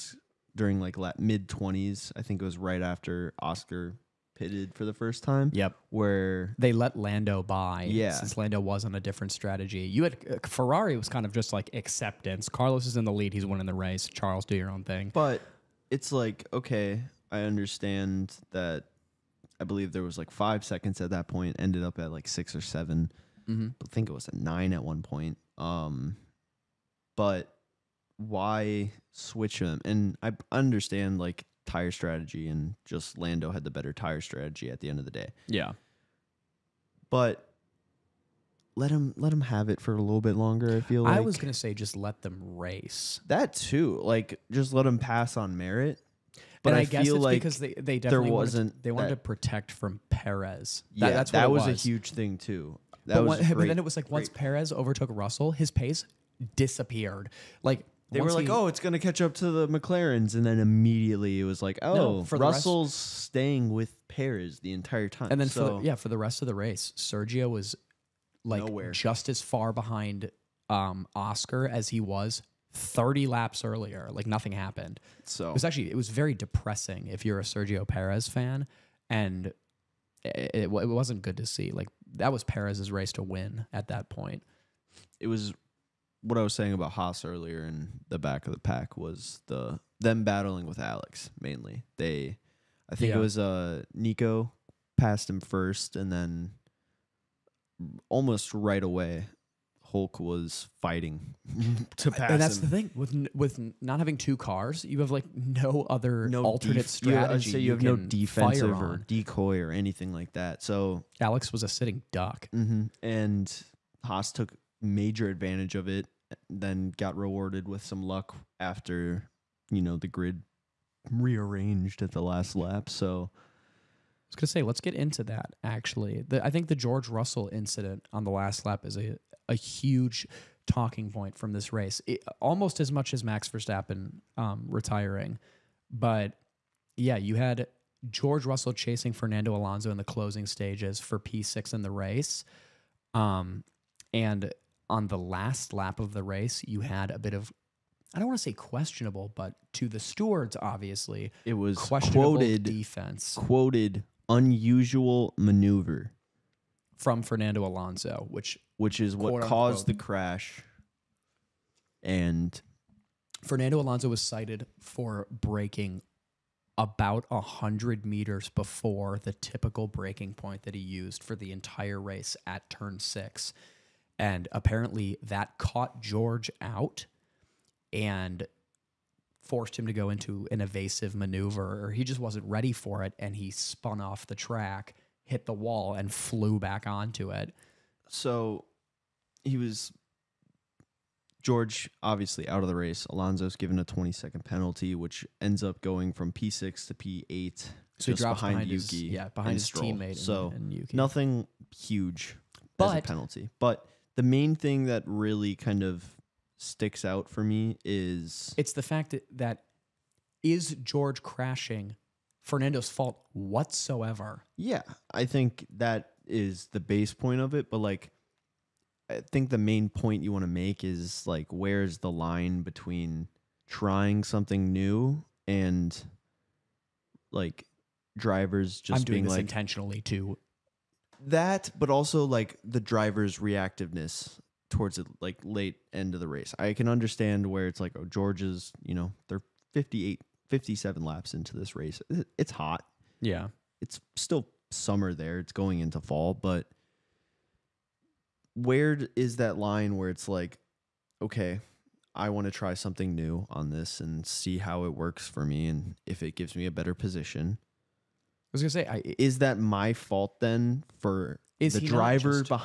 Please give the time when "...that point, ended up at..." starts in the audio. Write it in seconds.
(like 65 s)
21 s.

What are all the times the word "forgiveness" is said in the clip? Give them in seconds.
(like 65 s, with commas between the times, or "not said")
not said.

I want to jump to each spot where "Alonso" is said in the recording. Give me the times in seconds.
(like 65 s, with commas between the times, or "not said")
139 s, 157 s, 163 s, 193 s.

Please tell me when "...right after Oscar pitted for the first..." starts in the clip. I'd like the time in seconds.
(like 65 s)
2 s.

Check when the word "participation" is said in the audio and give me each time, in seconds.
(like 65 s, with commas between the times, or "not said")
not said.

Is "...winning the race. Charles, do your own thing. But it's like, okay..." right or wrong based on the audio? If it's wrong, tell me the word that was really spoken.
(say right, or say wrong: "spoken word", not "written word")
right.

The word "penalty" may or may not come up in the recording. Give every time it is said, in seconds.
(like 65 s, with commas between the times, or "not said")
194 s, 203 s.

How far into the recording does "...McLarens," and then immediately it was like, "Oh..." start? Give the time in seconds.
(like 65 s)
59 s.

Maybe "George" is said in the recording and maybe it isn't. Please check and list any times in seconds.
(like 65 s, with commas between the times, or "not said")
126 s, 138 s, 176 s, 191 s, 210 s, 238 s.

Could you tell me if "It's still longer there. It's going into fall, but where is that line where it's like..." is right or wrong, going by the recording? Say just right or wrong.
wrong.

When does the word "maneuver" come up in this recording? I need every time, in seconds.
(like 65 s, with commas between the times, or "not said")
155 s, 181 s.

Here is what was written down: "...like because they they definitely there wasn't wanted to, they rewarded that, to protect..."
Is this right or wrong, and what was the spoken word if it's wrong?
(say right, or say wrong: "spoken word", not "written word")
wrong: "wanted", not "rewarded".